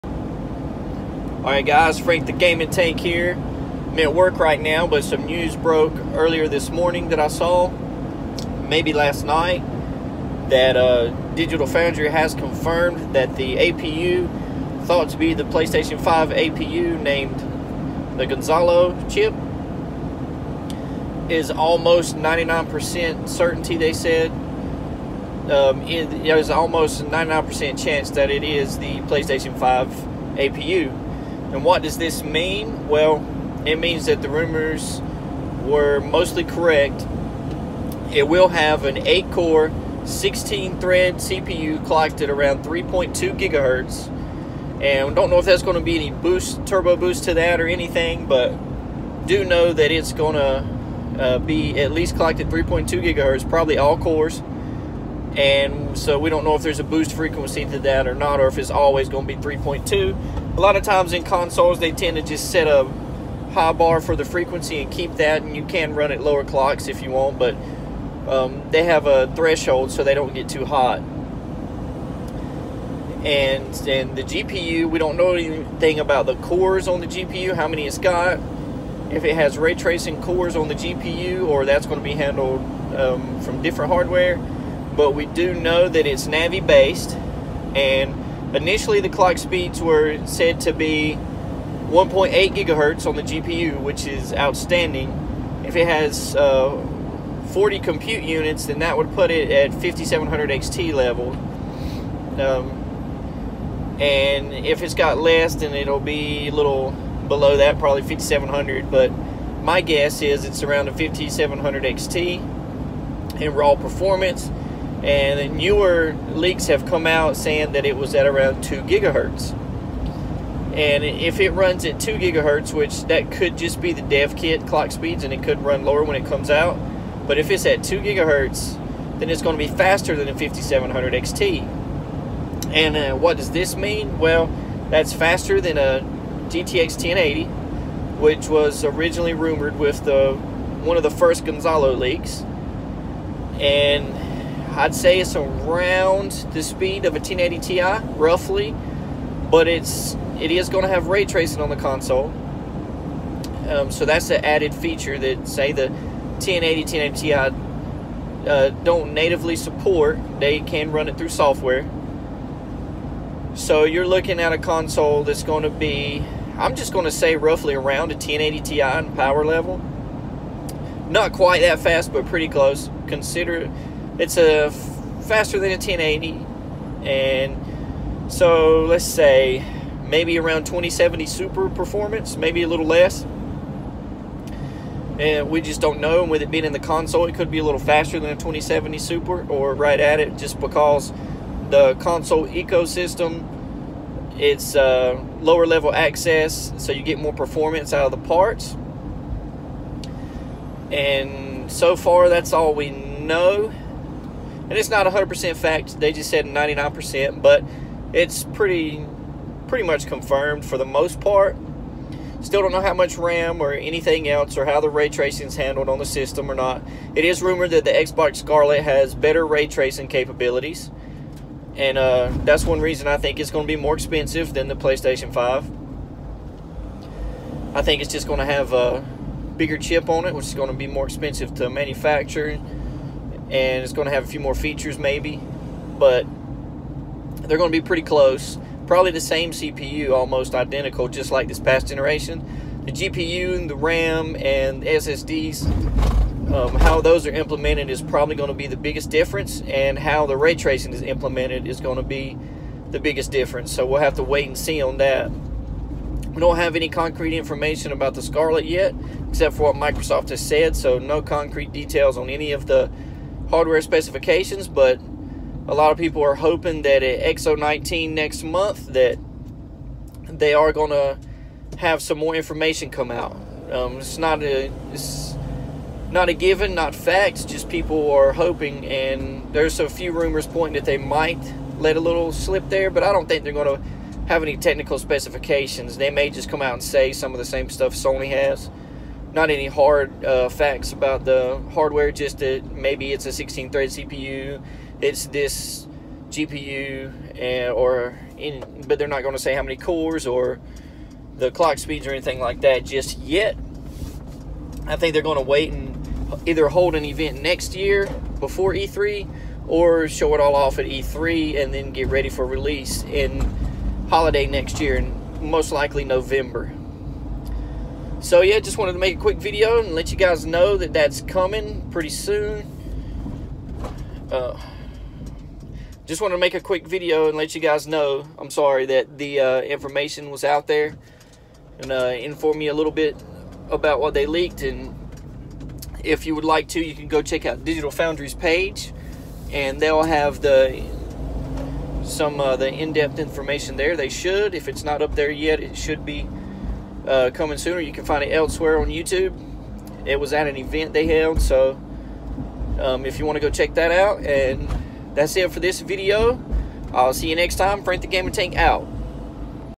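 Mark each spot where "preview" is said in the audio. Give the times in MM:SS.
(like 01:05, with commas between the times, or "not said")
not said.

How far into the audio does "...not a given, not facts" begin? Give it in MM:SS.
04:36.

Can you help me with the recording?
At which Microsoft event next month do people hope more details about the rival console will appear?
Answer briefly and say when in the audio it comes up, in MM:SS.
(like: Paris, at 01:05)
X019, at 04:27.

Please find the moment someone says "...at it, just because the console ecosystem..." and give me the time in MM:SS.
03:09.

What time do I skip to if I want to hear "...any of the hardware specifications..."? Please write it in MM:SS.
04:22.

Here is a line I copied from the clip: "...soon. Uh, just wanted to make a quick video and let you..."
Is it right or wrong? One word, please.
right.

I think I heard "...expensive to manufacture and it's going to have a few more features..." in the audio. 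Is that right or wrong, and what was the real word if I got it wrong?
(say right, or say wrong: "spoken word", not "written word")
right.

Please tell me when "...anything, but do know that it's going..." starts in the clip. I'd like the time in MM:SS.
00:47.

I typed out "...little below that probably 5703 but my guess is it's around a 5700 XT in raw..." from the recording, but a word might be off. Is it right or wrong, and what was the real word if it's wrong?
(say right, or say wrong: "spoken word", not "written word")
wrong: "5700", not "5703".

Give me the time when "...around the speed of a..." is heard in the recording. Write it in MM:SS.
02:25.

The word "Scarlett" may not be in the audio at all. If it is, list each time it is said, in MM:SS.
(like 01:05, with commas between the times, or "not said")
03:38, 04:18.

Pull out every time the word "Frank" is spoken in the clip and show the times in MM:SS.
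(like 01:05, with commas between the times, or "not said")
00:01, 05:57.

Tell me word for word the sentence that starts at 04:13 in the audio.
So we'll have to wait and see on that.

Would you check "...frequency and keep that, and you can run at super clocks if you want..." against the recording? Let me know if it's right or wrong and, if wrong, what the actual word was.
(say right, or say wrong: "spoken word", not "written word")
wrong: "lower", not "super".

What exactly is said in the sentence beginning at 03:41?
And uh, that's one reason I think it's going to be more expensive than the PlayStation 5.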